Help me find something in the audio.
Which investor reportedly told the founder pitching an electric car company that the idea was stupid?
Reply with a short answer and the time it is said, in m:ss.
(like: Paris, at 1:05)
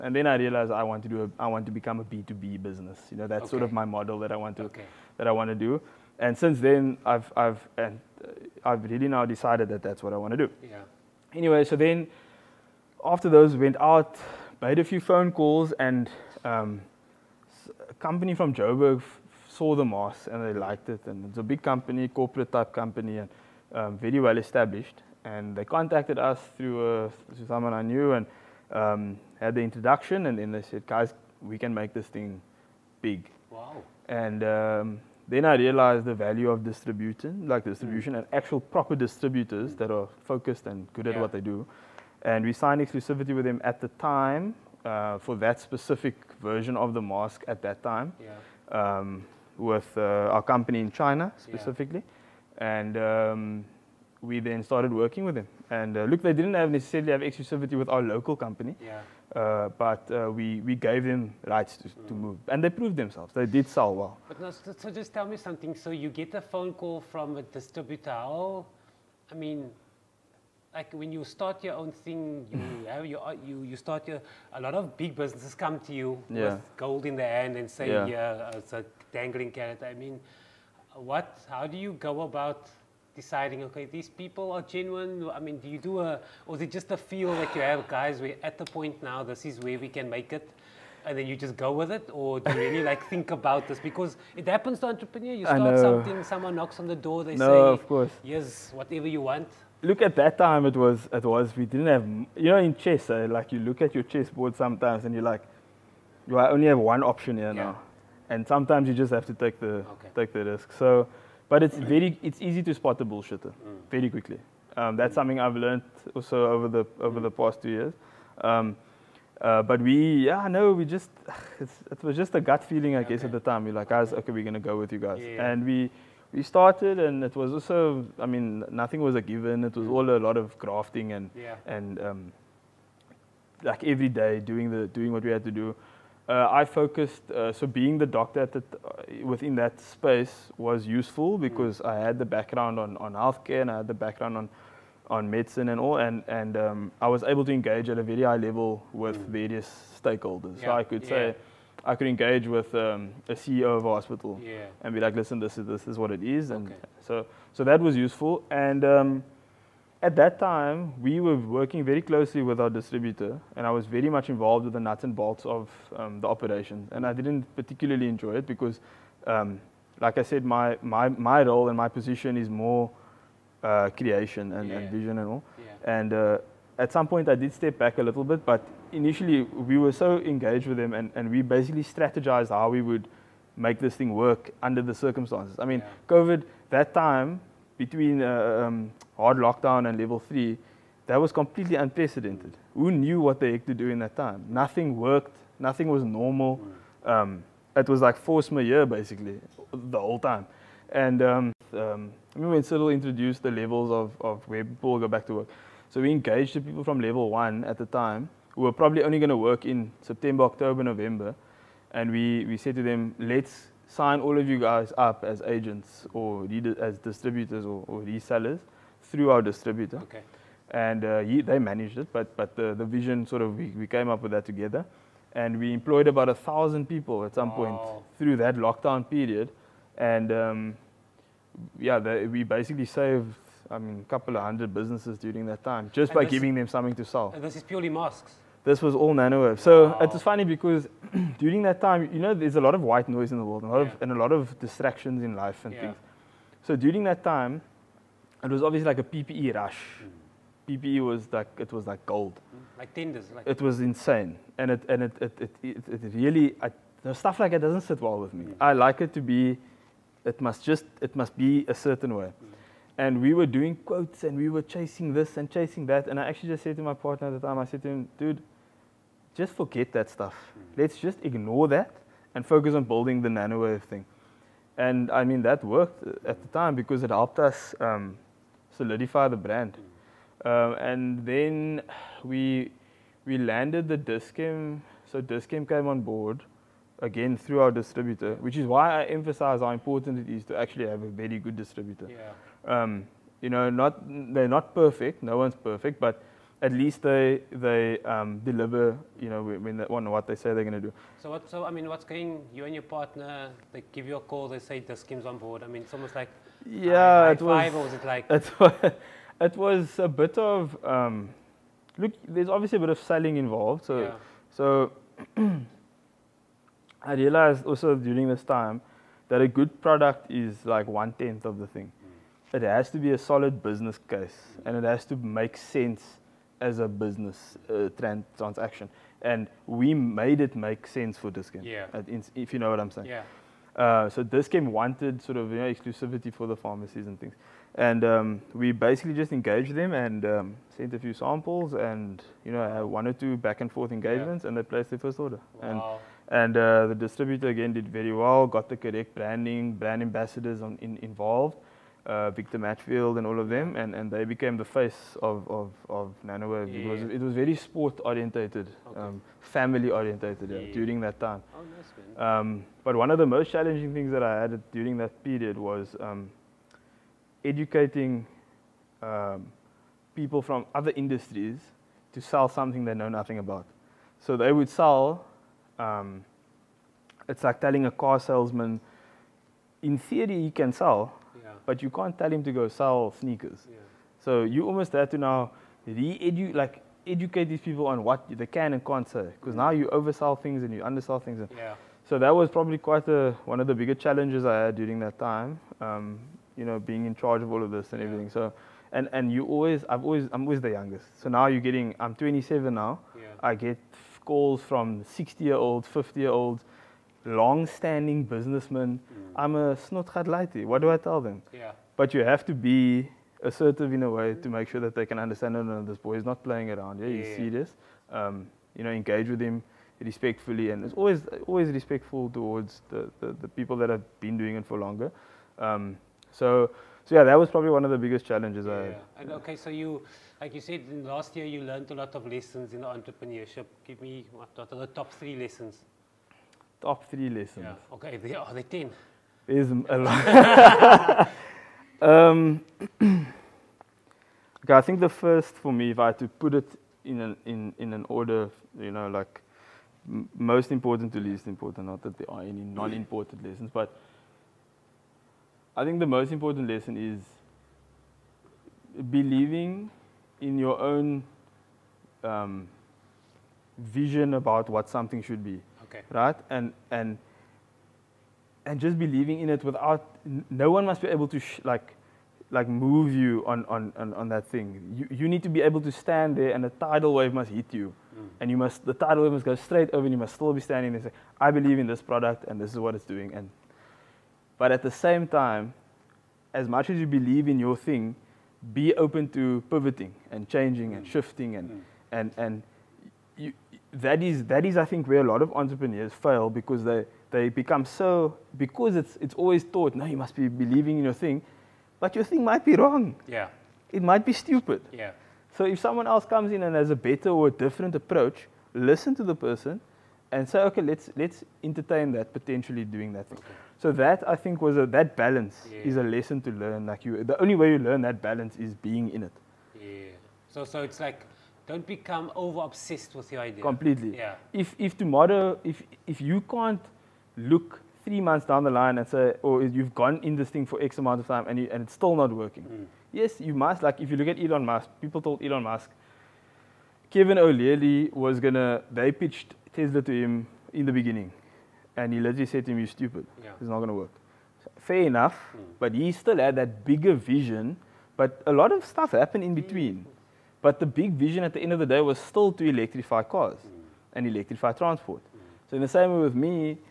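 Kevin O'Leary, at 8:57.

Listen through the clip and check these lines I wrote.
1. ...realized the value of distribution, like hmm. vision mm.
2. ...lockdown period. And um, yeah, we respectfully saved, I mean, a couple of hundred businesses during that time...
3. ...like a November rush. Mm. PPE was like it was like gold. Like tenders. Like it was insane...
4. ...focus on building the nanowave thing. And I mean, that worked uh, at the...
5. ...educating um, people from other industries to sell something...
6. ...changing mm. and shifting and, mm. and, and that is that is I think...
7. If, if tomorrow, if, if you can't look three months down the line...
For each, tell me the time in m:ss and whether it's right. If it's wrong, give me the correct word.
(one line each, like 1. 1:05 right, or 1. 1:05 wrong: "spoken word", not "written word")
1. 0:35 wrong: "distribution", not "vision"
2. 3:48 wrong: "basically", not "respectfully"
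3. 4:08 wrong: "PPE", not "November"
4. 4:32 right
5. 6:07 right
6. 8:10 right
7. 8:44 right.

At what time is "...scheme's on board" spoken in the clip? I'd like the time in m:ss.
5:04.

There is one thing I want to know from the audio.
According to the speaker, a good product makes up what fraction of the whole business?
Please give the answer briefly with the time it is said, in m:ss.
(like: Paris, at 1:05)
One tenth, at 5:20.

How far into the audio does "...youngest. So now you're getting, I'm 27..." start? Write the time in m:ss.
6:40.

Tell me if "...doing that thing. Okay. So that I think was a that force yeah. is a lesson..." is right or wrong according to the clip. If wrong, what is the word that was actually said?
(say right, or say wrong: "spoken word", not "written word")
wrong: "balance", not "force".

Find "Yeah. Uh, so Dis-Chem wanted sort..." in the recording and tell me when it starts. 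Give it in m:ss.
5:33.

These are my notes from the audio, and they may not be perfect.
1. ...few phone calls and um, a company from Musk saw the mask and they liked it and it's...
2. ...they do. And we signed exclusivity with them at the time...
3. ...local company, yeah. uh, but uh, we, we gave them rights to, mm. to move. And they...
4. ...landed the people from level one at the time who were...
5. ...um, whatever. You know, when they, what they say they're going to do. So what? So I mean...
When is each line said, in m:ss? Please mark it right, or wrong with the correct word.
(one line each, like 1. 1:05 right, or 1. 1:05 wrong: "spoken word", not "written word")
1. 0:14 wrong: "Joburg", not "Musk"
2. 0:41 right
3. 0:58 right
4. 3:26 wrong: "engaged", not "landed"
5. 4:58 wrong: "deliver", not "whatever".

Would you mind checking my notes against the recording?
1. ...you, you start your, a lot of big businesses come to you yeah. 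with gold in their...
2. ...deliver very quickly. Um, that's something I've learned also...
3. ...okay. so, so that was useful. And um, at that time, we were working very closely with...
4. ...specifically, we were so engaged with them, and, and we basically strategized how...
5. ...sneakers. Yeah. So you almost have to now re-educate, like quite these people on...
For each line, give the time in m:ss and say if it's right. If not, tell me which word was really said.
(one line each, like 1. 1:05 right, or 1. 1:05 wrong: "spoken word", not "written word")
1. 1:13 right
2. 1:53 wrong: "bullshitter", not "deliver"
3. 2:36 right
4. 2:58 wrong: "initially", not "specifically"
5. 6:23 wrong: "educate", not "quite".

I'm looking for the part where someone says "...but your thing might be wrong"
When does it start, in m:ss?
8:21.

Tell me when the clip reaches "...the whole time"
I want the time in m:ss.
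3:19.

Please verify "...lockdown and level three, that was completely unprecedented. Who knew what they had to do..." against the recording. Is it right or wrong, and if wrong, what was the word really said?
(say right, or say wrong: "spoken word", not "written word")
right.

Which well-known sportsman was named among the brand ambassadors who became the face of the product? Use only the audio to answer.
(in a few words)
Victor Matfield.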